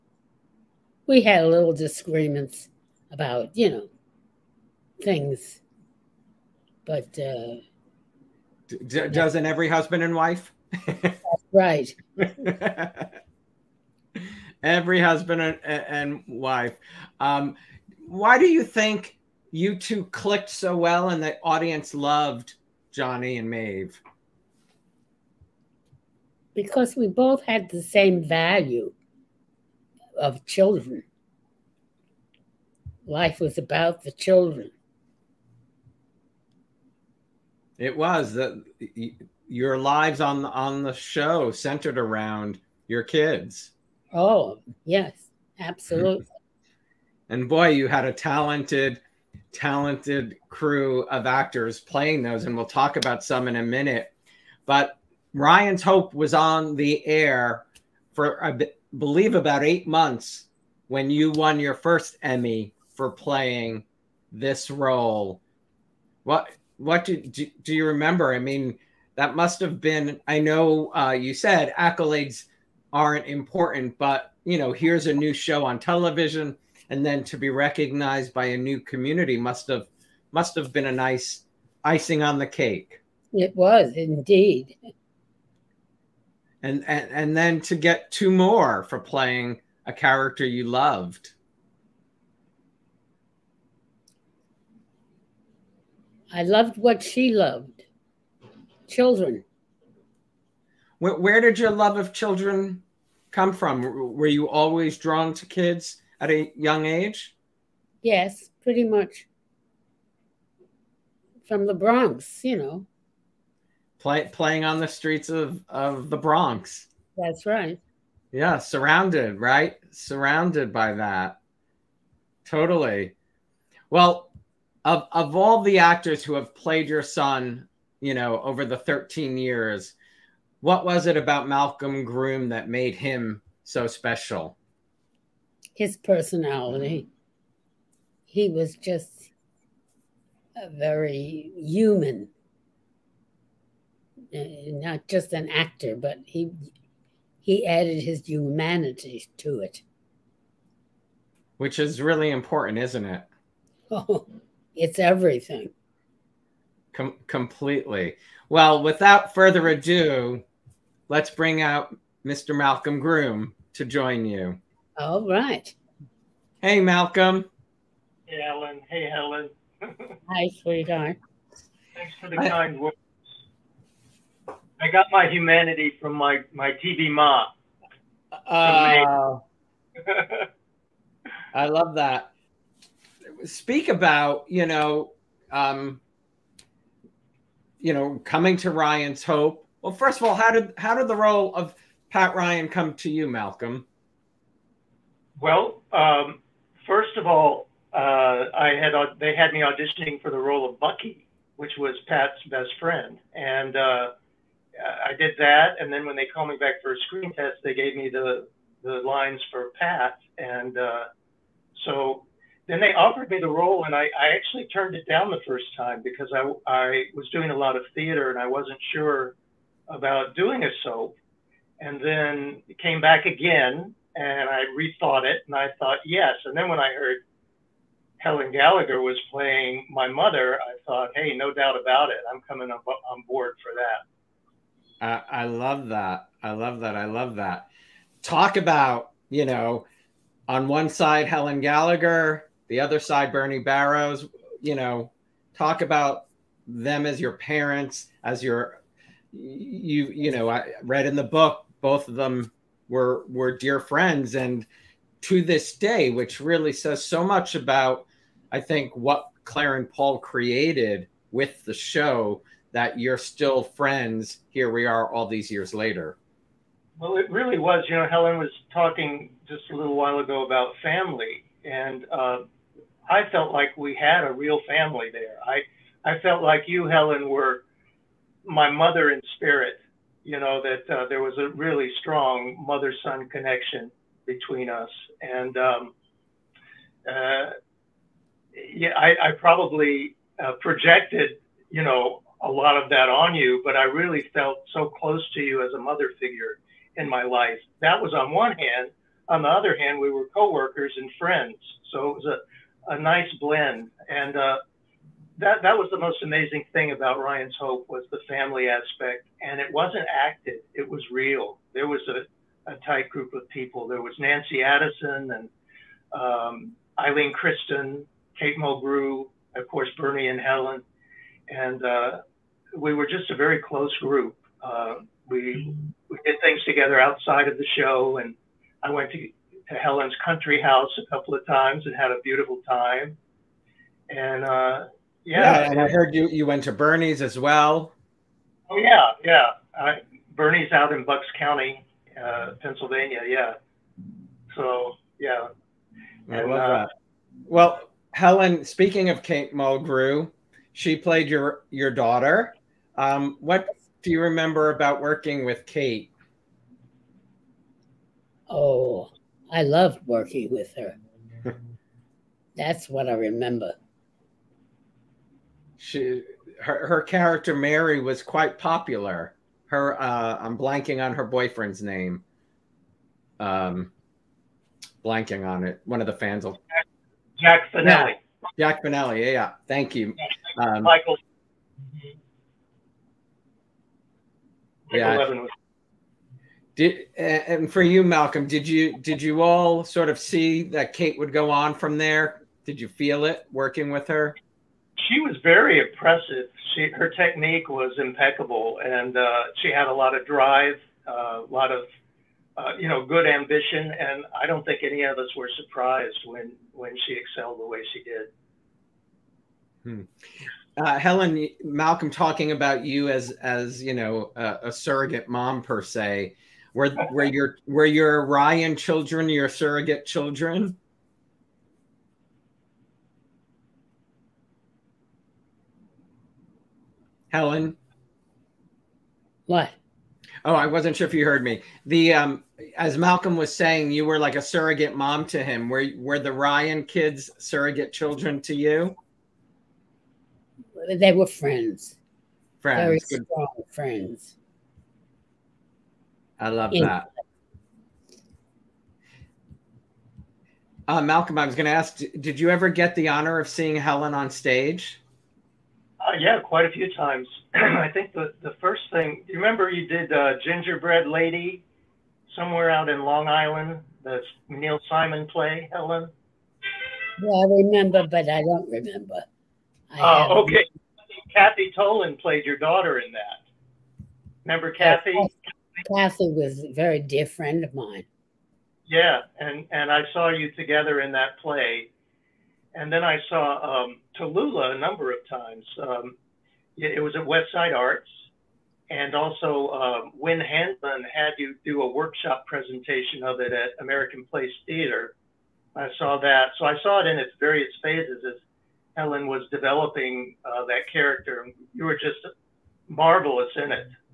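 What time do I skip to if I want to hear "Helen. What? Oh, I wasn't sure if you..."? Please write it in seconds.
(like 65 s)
427 s.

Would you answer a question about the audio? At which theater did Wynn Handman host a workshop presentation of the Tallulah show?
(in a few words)
American Place Theater.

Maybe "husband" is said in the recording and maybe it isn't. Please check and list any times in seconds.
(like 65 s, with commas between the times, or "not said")
9 s, 15 s.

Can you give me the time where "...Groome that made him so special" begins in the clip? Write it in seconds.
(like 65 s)
132 s.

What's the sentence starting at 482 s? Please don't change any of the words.
And then I saw um, Tallulah a number of times.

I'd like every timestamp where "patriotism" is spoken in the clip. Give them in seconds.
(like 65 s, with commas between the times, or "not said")
not said.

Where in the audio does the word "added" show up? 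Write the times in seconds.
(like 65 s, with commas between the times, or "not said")
147 s.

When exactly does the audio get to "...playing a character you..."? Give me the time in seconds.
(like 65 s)
88 s.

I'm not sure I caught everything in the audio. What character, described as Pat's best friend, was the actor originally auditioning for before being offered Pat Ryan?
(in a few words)
Bucky.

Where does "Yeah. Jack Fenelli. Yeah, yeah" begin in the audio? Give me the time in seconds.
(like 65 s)
378 s.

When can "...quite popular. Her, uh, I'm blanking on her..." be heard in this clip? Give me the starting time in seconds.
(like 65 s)
368 s.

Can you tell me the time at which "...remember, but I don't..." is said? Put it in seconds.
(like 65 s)
467 s.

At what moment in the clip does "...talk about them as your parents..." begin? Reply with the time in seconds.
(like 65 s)
245 s.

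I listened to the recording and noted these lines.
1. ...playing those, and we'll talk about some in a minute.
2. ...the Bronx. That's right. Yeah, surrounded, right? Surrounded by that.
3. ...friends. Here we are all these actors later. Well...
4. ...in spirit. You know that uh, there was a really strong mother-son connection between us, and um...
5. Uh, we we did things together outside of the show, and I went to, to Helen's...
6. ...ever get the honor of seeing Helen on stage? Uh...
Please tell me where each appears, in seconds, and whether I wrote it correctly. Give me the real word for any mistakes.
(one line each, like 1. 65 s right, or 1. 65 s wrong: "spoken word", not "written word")
1. 51 s right
2. 116 s right
3. 263 s wrong: "years", not "actors"
4. 279 s right
5. 324 s right
6. 452 s right.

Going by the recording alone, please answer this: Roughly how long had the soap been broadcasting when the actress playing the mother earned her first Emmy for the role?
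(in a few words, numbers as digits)
8 months.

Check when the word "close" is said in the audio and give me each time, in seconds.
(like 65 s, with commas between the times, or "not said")
294 s, 323 s.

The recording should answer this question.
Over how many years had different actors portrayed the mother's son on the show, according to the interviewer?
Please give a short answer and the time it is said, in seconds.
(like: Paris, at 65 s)
13, at 128 s.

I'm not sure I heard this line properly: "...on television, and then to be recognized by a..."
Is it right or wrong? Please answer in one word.
right.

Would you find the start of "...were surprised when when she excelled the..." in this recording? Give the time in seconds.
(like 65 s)
405 s.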